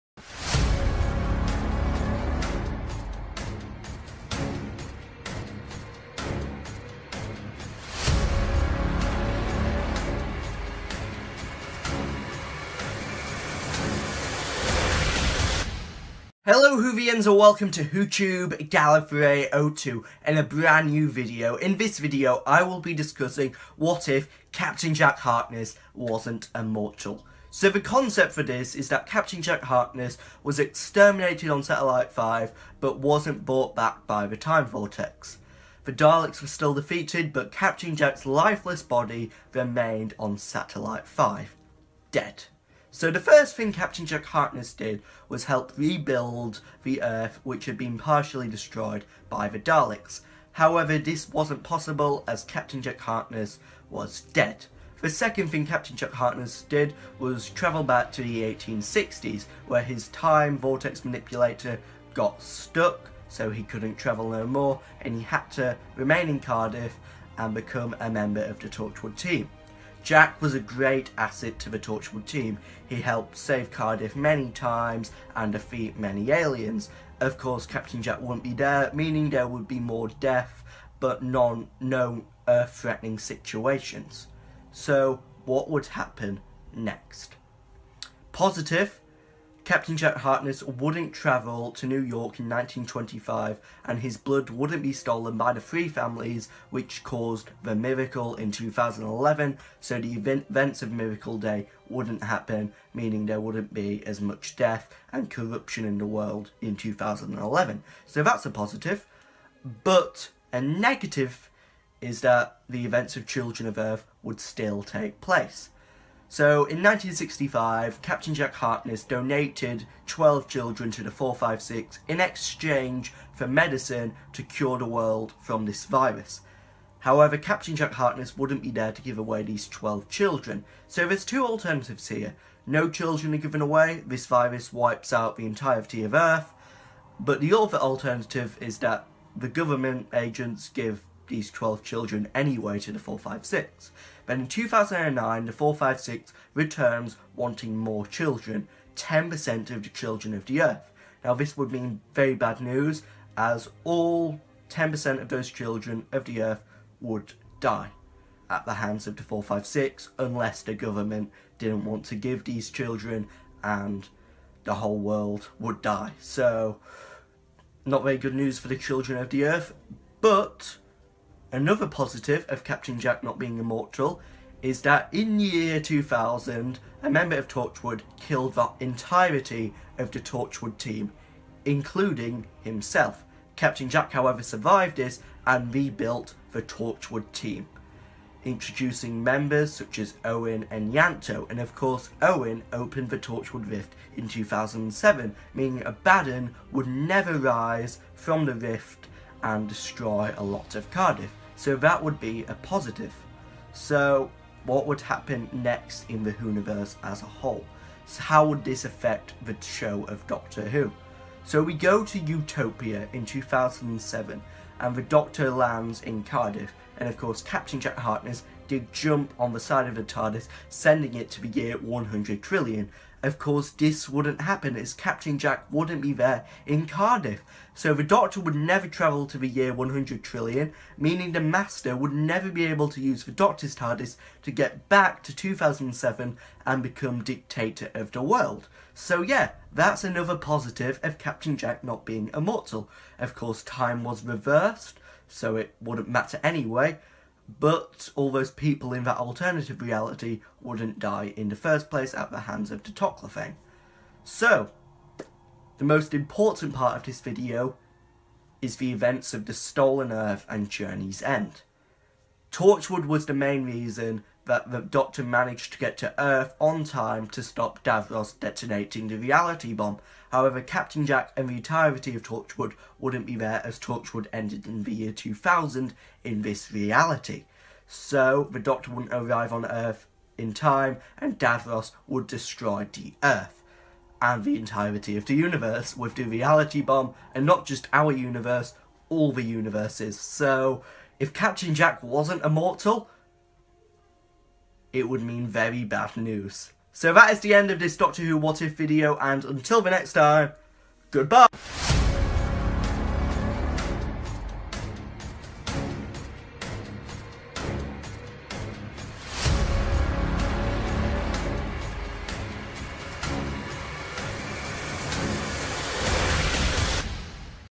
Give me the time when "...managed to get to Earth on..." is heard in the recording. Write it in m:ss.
4:25.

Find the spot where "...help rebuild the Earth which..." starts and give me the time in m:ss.
0:45.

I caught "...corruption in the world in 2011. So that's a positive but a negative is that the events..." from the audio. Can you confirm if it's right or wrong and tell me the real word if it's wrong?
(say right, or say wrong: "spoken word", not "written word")
right.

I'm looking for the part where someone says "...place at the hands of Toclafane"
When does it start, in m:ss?
4:11.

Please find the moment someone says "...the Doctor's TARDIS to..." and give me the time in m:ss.
3:53.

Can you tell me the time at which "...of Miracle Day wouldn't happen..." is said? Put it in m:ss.
1:40.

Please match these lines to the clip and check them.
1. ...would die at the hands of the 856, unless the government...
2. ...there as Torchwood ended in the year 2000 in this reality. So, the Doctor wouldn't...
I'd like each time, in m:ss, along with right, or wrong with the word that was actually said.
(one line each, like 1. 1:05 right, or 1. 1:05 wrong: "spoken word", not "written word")
1. 2:36 wrong: "456", not "856"
2. 4:33 right.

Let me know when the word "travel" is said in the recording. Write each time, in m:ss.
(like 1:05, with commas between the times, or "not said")
0:57, 1:03, 1:31, 3:48.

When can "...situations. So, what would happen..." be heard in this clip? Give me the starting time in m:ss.
1:23.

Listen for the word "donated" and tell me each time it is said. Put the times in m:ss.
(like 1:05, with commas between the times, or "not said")
1:59.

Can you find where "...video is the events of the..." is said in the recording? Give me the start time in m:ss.
4:17.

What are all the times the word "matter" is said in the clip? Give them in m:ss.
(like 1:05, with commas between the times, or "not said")
4:06.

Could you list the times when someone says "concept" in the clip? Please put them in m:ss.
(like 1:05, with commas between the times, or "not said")
0:27.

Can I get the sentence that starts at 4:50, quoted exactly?
So, if Captain Jack wasn't immortal, it would mean very bad news.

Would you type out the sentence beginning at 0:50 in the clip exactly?
However, this wasn't possible as Captain Jack Harkness was dead.